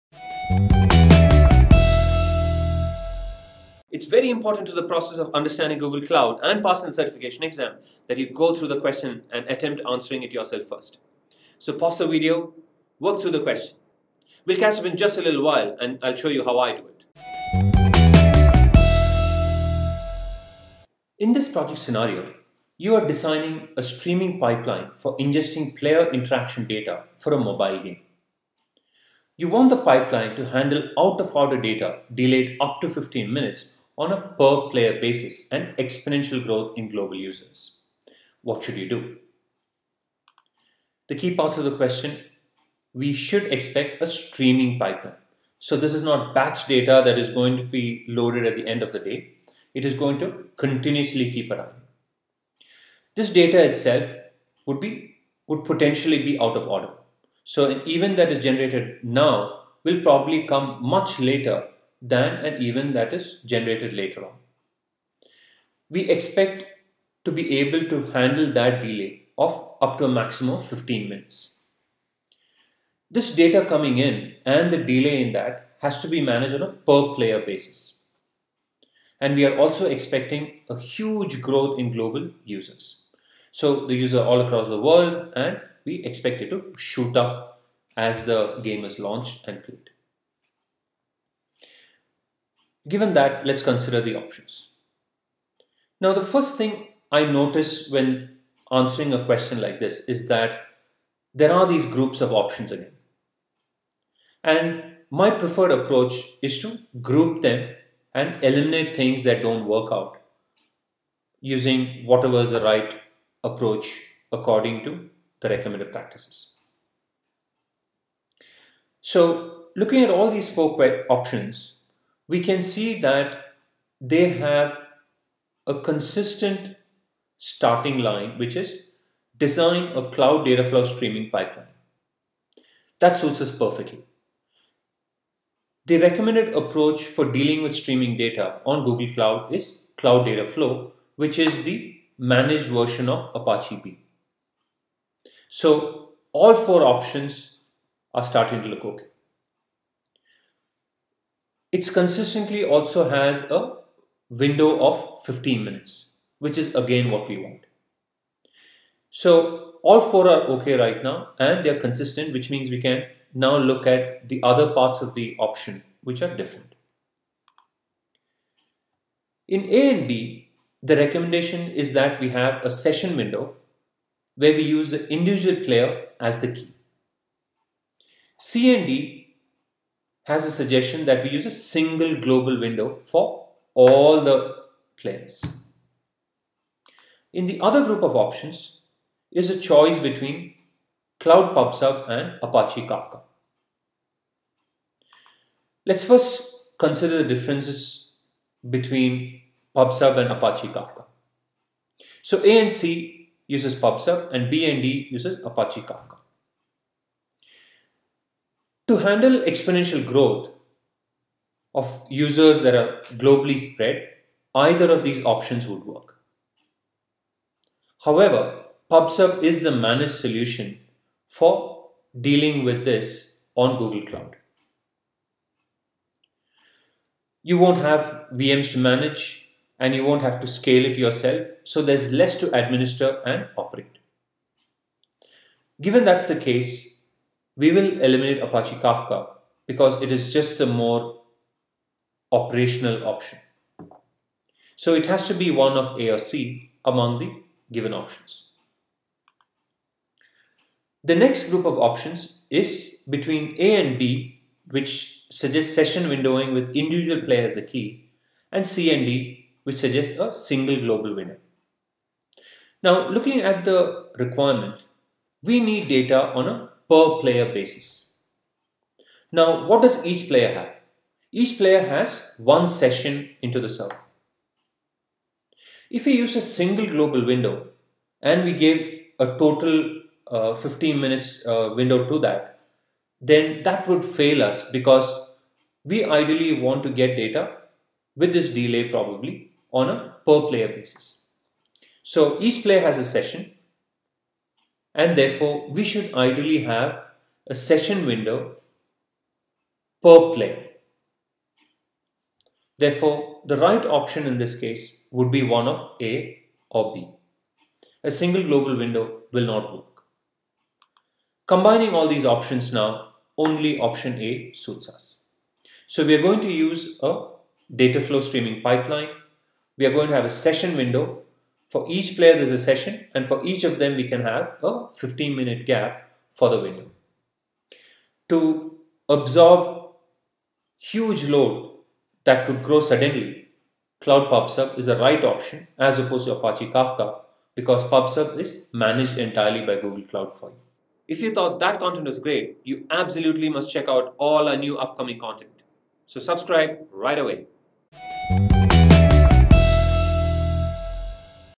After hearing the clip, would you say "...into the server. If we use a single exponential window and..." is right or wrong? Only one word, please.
wrong.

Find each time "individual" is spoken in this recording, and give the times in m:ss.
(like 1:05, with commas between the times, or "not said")
2:55, 4:16.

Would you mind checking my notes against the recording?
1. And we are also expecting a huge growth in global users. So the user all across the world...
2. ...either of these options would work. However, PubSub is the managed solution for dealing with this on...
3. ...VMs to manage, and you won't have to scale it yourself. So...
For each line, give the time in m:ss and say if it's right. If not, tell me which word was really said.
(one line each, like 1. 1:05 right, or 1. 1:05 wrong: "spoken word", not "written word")
1. 1:19 right
2. 3:34 right
3. 3:48 right.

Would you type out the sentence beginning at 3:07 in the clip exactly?
In the other group of options is a choice between Cloud PubSub and Apache Kafka.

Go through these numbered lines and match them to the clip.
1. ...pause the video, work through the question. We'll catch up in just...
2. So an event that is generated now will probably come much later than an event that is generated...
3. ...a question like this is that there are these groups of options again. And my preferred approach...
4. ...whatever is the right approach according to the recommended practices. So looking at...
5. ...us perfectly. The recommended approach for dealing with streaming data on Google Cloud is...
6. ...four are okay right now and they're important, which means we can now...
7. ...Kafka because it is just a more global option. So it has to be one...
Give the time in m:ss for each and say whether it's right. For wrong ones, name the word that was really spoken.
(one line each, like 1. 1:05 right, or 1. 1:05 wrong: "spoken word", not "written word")
1. 0:11 right
2. 0:57 right
3. 1:39 right
4. 1:52 right
5. 2:13 right
6. 2:39 wrong: "consistent", not "important"
7. 3:58 wrong: "operational", not "global".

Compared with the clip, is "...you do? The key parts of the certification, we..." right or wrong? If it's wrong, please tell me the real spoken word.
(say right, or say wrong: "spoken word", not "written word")
wrong: "question", not "certification".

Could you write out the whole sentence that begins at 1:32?
Given that, let's consider the options.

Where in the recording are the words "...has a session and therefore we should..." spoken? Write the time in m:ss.
4:52.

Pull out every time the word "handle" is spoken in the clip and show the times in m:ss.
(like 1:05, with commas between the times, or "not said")
0:30, 1:08, 3:28.